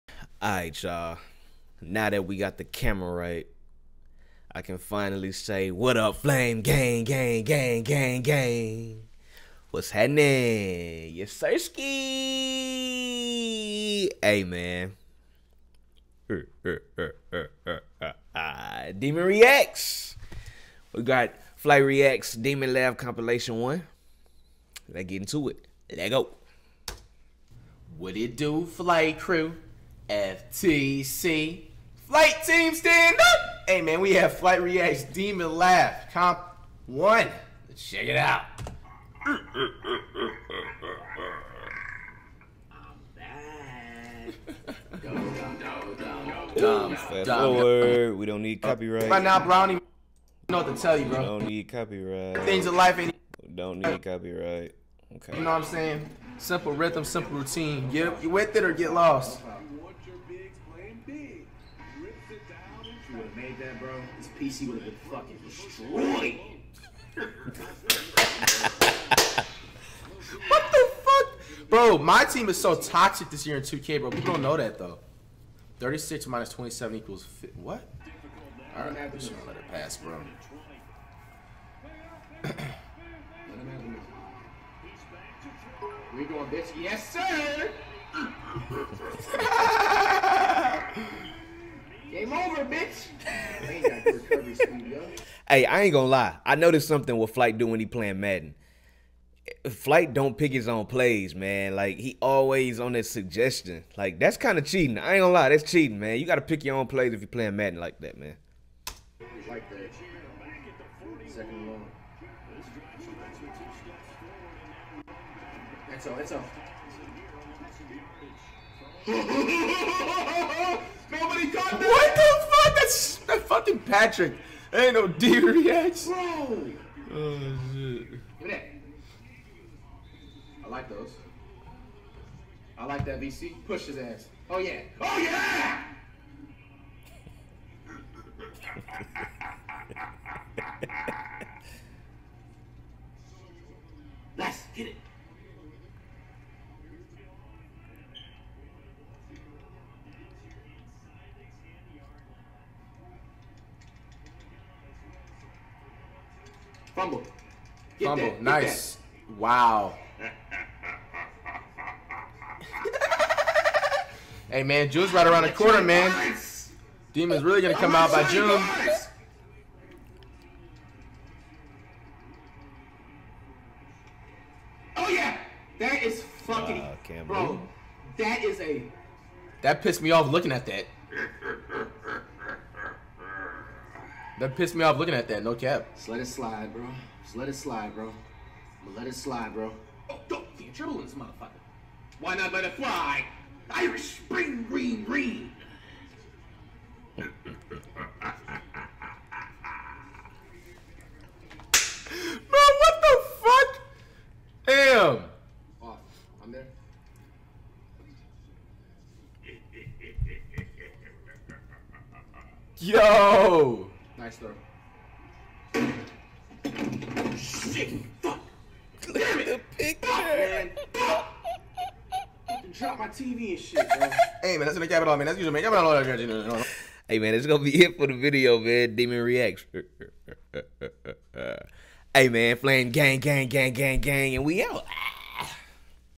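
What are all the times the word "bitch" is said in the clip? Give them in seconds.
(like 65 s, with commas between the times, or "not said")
86 s, 92 s.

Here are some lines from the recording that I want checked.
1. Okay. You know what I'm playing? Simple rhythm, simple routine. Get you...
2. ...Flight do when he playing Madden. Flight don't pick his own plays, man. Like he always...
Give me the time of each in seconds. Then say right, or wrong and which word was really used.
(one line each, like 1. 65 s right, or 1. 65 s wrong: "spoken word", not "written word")
1. 55 s wrong: "saying", not "playing"
2. 97 s right.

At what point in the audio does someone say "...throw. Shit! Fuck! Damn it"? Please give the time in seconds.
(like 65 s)
214 s.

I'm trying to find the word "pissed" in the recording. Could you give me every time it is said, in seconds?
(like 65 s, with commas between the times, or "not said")
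179 s, 184 s.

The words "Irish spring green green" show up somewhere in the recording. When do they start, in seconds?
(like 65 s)
193 s.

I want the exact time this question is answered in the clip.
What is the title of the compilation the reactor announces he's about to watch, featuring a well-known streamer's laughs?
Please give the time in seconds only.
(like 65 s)
34 s.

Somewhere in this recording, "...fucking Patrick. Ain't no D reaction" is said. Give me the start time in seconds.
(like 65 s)
123 s.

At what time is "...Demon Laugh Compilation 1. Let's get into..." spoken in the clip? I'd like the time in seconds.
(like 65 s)
22 s.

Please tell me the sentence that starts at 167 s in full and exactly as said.
Demon's really gonna come out by June.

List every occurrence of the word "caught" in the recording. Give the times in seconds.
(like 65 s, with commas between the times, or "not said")
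121 s.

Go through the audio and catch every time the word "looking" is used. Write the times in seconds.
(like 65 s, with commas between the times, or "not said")
180 s, 184 s.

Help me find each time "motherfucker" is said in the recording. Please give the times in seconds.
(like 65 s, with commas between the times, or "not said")
191 s.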